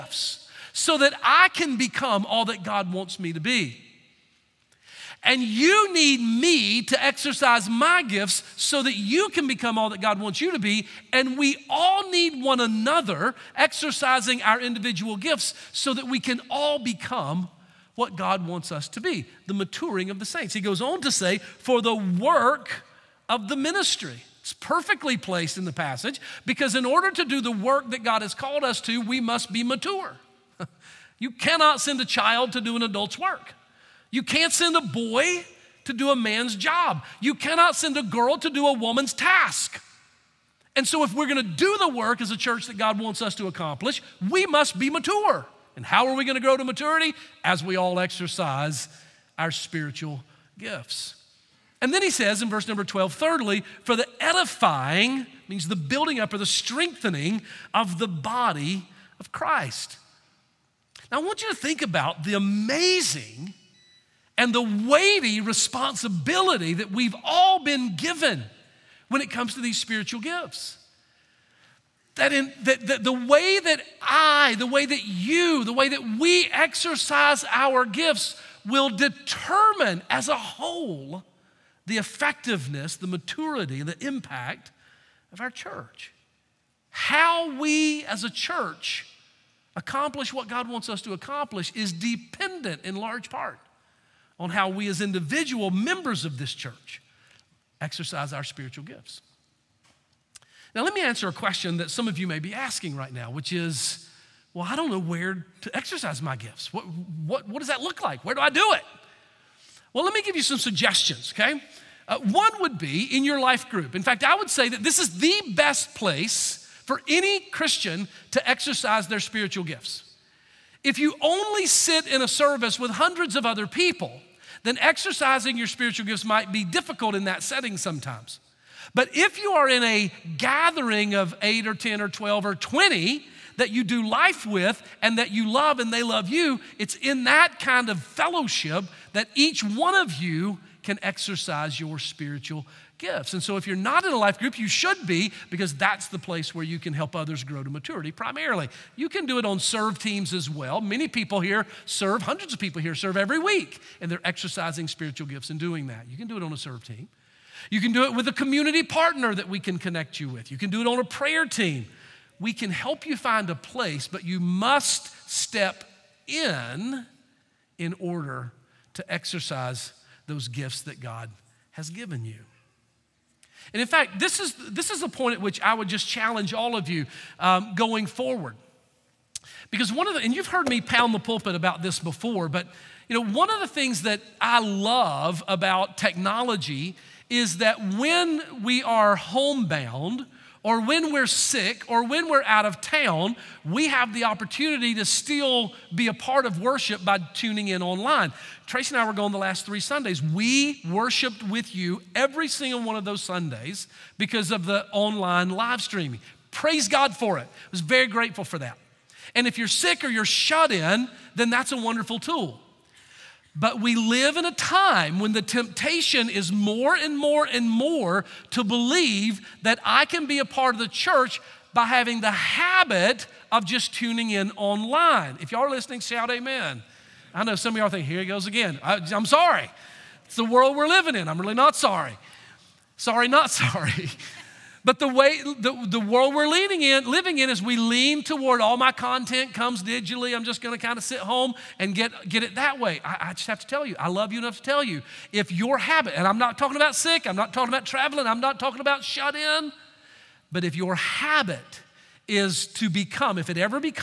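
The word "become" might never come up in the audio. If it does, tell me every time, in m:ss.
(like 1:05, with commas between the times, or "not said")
0:01, 0:09, 0:16, 4:12.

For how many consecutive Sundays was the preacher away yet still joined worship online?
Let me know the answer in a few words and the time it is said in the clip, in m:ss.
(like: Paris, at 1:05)
3, at 3:19.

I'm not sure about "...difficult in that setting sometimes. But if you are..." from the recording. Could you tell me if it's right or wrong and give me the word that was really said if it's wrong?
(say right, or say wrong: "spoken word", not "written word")
right.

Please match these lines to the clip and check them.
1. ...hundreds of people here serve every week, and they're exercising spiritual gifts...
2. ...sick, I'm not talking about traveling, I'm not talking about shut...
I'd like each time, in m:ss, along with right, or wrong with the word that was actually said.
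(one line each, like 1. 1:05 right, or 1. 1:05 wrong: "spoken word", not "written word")
1. 2:32 right
2. 4:06 right.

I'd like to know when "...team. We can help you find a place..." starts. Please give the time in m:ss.
2:41.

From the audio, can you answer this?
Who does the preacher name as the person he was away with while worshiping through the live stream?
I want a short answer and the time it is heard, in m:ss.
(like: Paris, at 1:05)
Tracy, at 3:18.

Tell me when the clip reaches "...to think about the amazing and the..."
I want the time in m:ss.
1:01.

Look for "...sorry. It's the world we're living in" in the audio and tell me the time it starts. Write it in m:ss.
3:49.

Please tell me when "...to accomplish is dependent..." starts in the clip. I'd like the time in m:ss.
1:31.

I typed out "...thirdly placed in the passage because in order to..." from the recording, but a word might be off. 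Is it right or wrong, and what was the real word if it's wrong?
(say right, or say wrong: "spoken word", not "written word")
wrong: "perfectly", not "thirdly".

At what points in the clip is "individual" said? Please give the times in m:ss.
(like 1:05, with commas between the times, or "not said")
0:14, 1:34.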